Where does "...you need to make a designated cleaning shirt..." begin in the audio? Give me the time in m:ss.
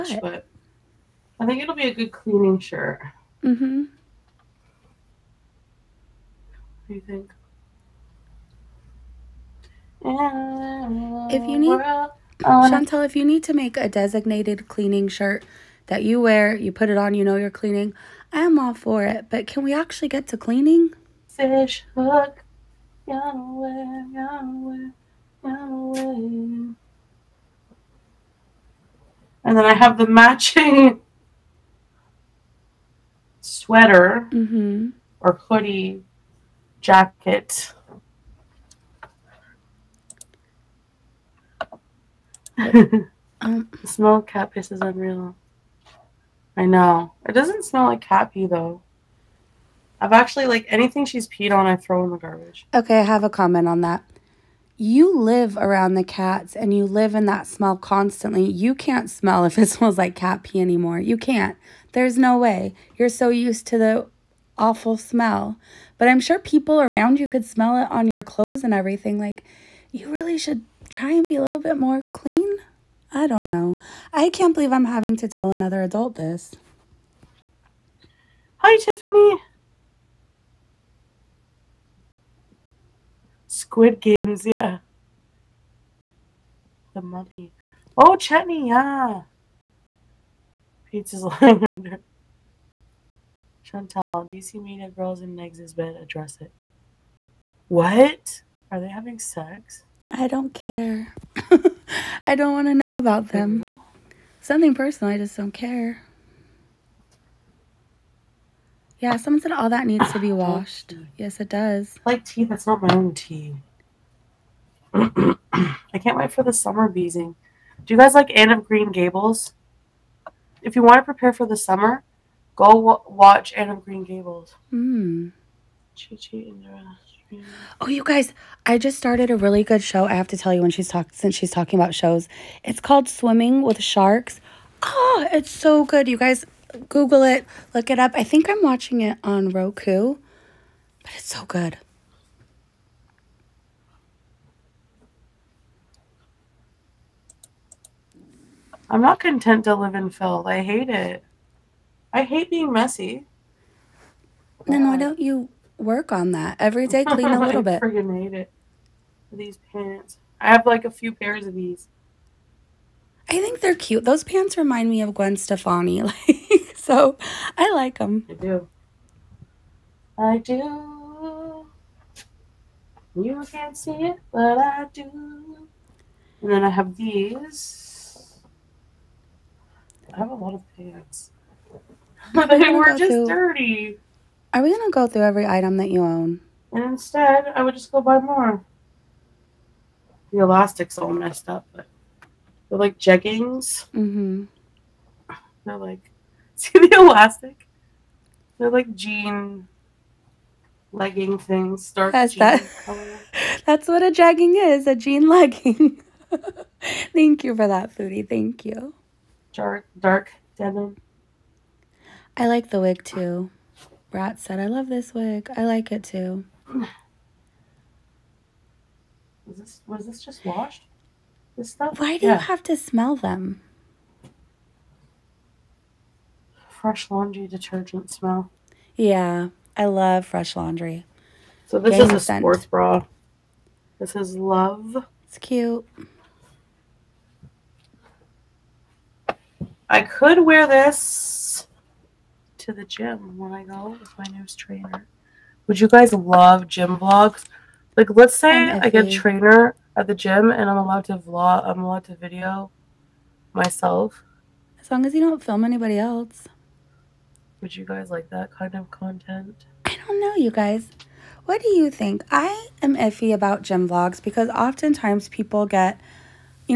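0:13.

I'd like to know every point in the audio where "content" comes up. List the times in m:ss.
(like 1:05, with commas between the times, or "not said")
2:29, 4:18.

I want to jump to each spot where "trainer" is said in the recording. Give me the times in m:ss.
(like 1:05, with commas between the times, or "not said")
4:04, 4:09.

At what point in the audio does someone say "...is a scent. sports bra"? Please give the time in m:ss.
3:51.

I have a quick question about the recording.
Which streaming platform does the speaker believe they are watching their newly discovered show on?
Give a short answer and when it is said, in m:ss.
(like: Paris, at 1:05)
Roku, at 2:19.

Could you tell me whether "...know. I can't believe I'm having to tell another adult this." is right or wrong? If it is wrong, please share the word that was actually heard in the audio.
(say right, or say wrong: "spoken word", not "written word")
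right.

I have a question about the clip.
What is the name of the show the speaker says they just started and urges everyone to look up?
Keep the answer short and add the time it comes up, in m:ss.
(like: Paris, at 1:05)
Swimming with Sharks, at 2:13.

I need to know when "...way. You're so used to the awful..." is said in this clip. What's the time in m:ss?
1:02.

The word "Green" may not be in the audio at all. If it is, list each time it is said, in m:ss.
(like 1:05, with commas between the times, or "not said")
1:58, 2:03.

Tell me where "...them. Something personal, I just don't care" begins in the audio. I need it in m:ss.
1:43.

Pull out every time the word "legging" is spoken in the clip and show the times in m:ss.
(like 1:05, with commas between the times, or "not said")
3:20, 3:25.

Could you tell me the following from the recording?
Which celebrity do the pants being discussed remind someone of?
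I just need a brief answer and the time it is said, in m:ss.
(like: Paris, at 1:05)
Gwen Stefani, at 2:45.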